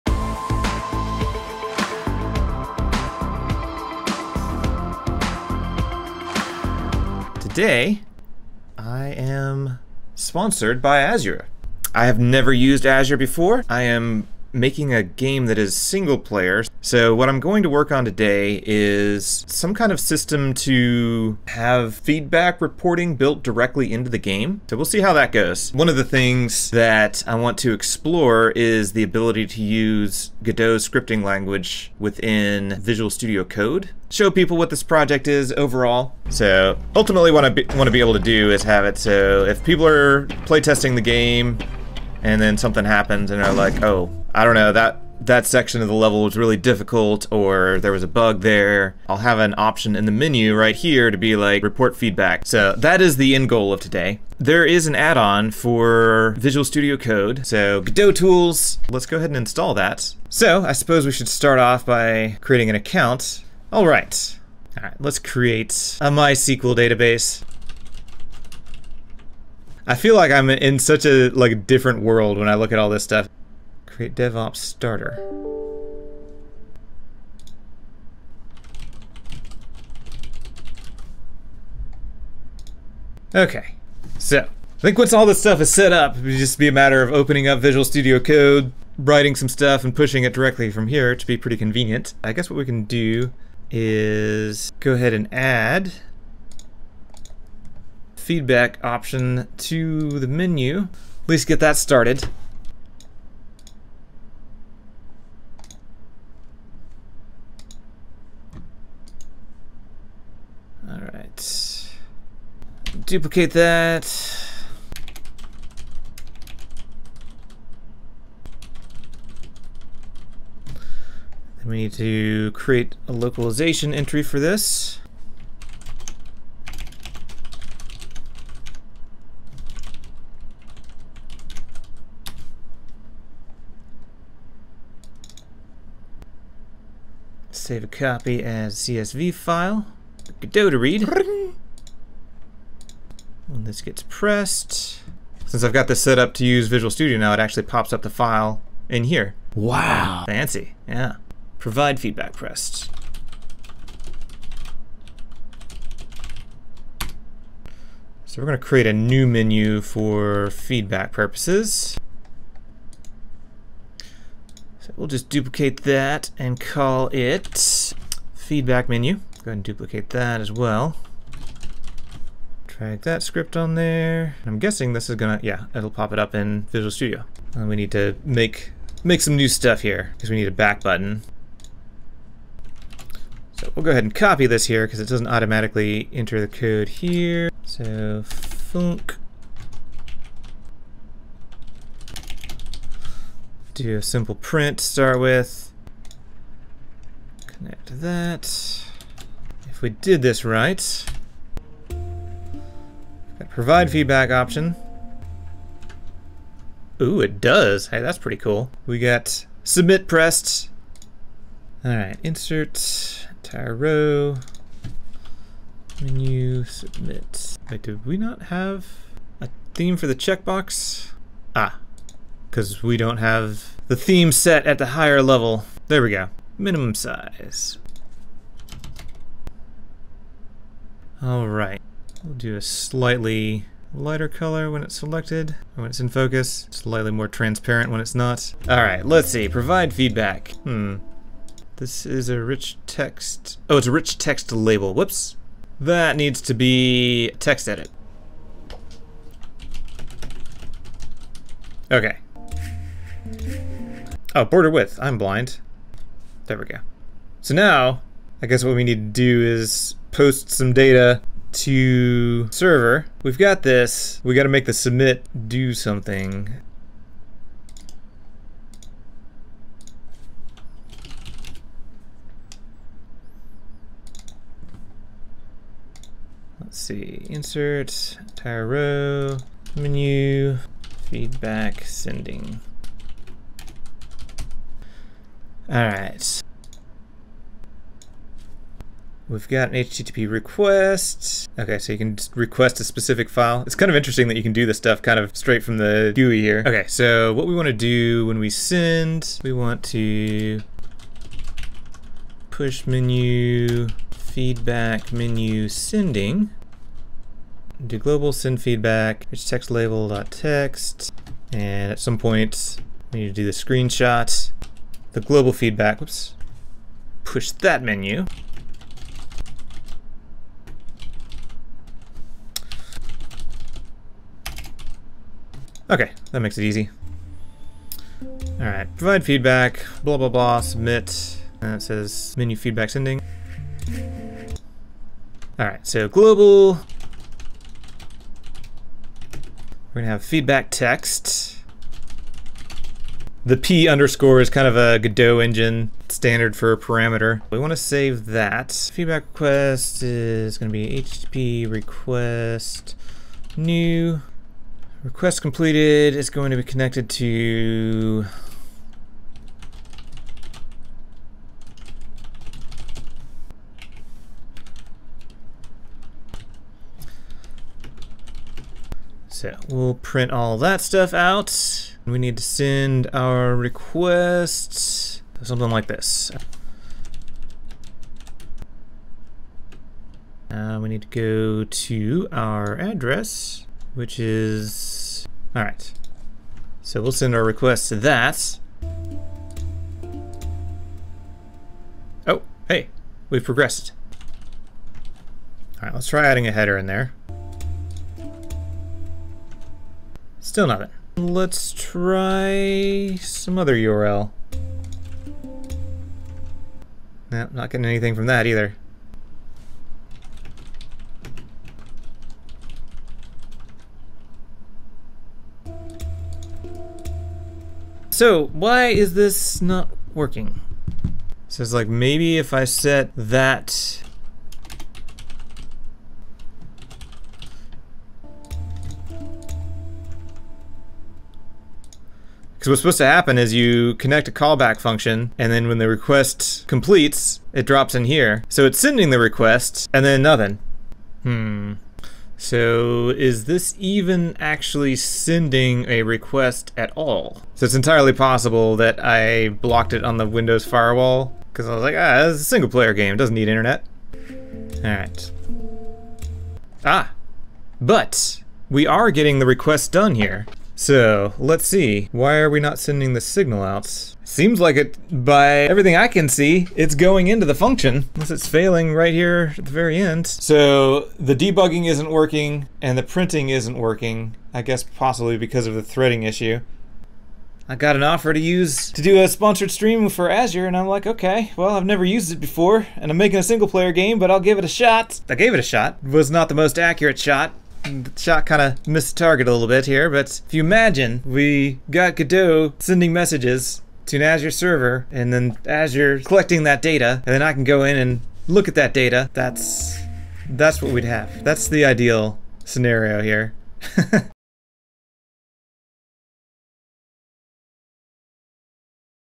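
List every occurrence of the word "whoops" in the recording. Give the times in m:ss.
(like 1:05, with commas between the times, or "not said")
4:04, 5:16.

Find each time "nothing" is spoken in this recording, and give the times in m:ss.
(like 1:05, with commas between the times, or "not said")
6:40, 7:20.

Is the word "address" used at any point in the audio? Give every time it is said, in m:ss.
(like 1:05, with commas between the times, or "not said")
6:22.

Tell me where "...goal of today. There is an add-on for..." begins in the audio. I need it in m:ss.
0:53.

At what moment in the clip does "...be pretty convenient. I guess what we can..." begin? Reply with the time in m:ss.
1:31.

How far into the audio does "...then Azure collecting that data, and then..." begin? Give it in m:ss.
8:15.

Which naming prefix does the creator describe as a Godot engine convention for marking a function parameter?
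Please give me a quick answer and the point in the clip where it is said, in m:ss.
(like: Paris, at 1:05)
P underscore, at 5:43.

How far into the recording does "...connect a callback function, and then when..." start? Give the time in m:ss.
7:13.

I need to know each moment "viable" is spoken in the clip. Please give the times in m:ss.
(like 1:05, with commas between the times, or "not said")
not said.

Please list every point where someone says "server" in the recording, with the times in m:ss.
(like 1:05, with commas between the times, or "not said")
4:22, 8:14.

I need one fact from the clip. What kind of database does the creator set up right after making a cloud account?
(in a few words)
MySQL.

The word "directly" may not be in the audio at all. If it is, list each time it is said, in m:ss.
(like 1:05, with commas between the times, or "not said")
0:23, 1:30.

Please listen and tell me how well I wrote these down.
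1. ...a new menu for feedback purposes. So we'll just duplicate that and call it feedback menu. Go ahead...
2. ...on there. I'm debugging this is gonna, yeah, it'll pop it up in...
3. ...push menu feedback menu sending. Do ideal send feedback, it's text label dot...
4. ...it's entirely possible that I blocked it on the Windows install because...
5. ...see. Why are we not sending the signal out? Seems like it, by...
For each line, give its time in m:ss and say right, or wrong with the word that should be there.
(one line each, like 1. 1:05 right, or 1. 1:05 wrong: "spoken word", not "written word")
1. 2:38 right
2. 2:53 wrong: "guessing", not "debugging"
3. 5:02 wrong: "global", not "ideal"
4. 7:27 wrong: "firewall", not "install"
5. 7:41 right.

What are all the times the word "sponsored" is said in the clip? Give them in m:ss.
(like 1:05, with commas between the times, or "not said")
0:10, 7:59.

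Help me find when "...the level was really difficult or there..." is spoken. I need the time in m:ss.
0:45.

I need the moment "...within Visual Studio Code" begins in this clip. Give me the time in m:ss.
0:31.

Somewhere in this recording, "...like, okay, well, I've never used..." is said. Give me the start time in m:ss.
8:00.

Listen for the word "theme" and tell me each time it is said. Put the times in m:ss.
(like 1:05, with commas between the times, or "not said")
3:39, 3:43.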